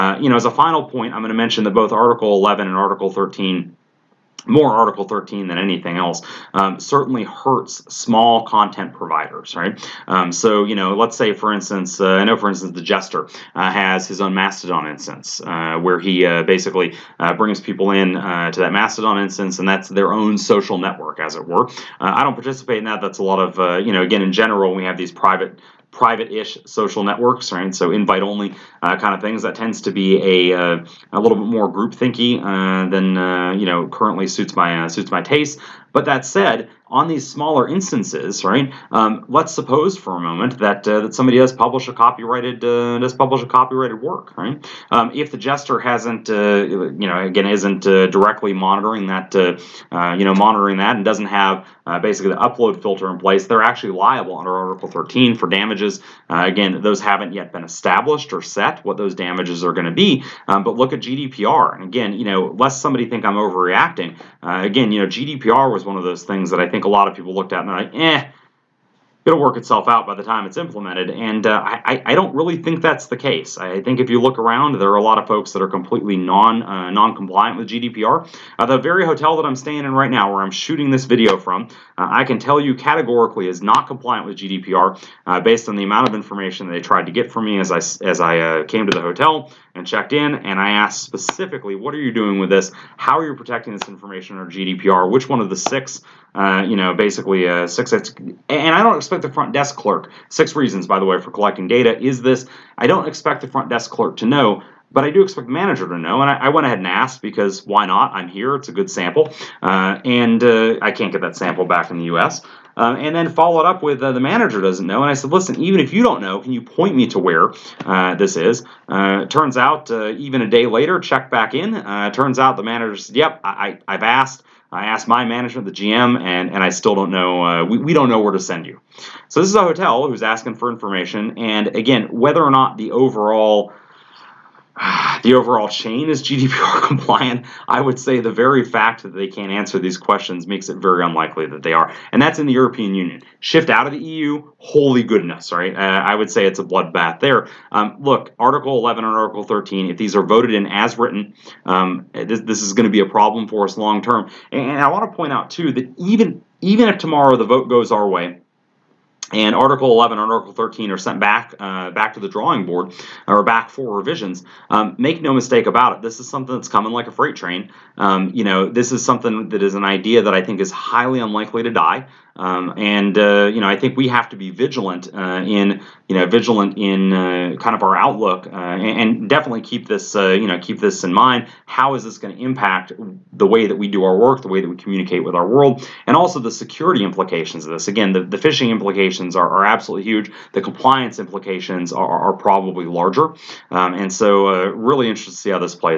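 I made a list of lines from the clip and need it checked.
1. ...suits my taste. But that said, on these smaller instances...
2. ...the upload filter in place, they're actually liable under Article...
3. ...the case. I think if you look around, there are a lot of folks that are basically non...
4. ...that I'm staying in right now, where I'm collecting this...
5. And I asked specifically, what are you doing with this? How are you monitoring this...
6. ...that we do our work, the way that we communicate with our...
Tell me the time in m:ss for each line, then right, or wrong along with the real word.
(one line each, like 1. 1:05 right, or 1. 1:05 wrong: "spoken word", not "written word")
1. 0:34 right
2. 0:52 right
3. 1:13 wrong: "completely", not "basically"
4. 1:19 wrong: "shooting", not "collecting"
5. 1:30 wrong: "protecting", not "monitoring"
6. 3:03 right.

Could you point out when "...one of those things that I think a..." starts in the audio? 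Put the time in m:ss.
1:05.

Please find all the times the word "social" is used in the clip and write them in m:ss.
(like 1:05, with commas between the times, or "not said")
0:20, 0:26.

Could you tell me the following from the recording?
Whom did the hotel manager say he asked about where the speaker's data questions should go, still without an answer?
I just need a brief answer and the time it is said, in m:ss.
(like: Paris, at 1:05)
the GM, at 2:05.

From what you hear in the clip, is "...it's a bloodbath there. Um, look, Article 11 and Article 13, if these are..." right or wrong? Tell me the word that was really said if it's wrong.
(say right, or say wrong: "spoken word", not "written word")
right.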